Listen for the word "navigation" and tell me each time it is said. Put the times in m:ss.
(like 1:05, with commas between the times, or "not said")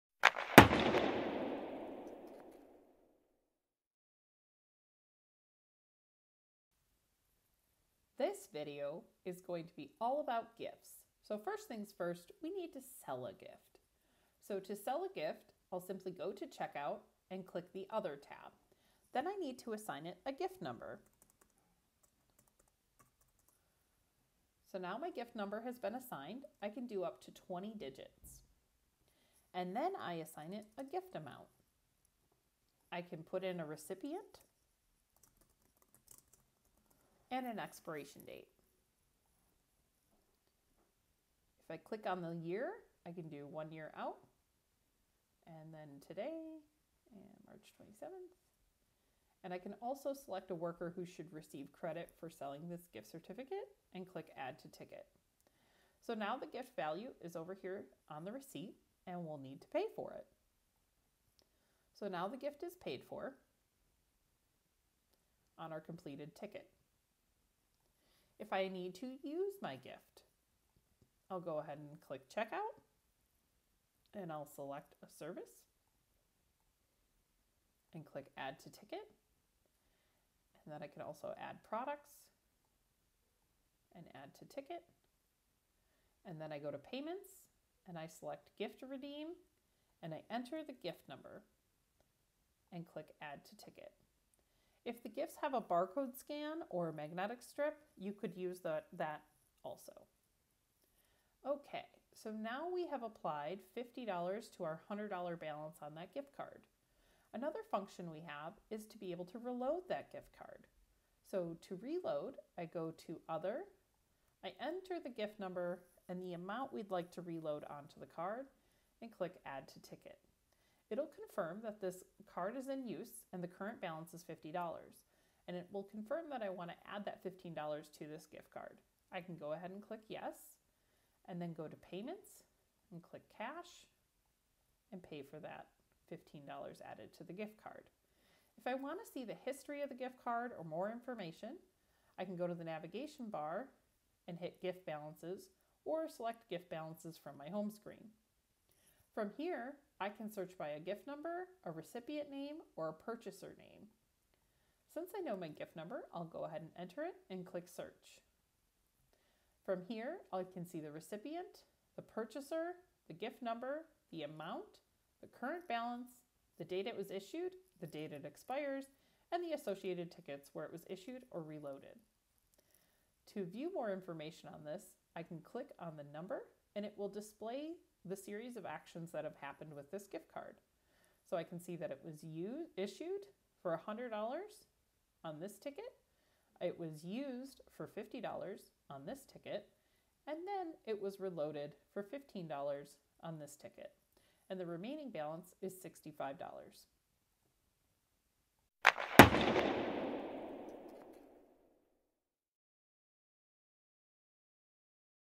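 2:22.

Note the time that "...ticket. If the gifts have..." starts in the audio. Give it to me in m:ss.
1:33.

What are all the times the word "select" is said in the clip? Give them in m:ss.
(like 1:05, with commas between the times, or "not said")
0:50, 1:14, 1:28, 2:26.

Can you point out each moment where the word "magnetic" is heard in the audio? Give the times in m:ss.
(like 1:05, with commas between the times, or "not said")
1:36.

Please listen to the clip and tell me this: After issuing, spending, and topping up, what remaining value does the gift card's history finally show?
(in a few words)
$65.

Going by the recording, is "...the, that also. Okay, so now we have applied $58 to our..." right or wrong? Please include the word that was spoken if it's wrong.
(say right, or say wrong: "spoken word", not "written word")
wrong: "50", not "58".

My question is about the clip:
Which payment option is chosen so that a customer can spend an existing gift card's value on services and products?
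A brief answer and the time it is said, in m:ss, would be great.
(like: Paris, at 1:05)
Gift redeem, at 1:28.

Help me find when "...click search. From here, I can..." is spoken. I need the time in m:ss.
2:37.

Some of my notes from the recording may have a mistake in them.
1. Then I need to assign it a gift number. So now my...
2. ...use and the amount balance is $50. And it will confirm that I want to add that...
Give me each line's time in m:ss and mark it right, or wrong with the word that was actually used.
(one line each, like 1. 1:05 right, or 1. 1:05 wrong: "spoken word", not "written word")
1. 0:19 right
2. 2:02 wrong: "current", not "amount".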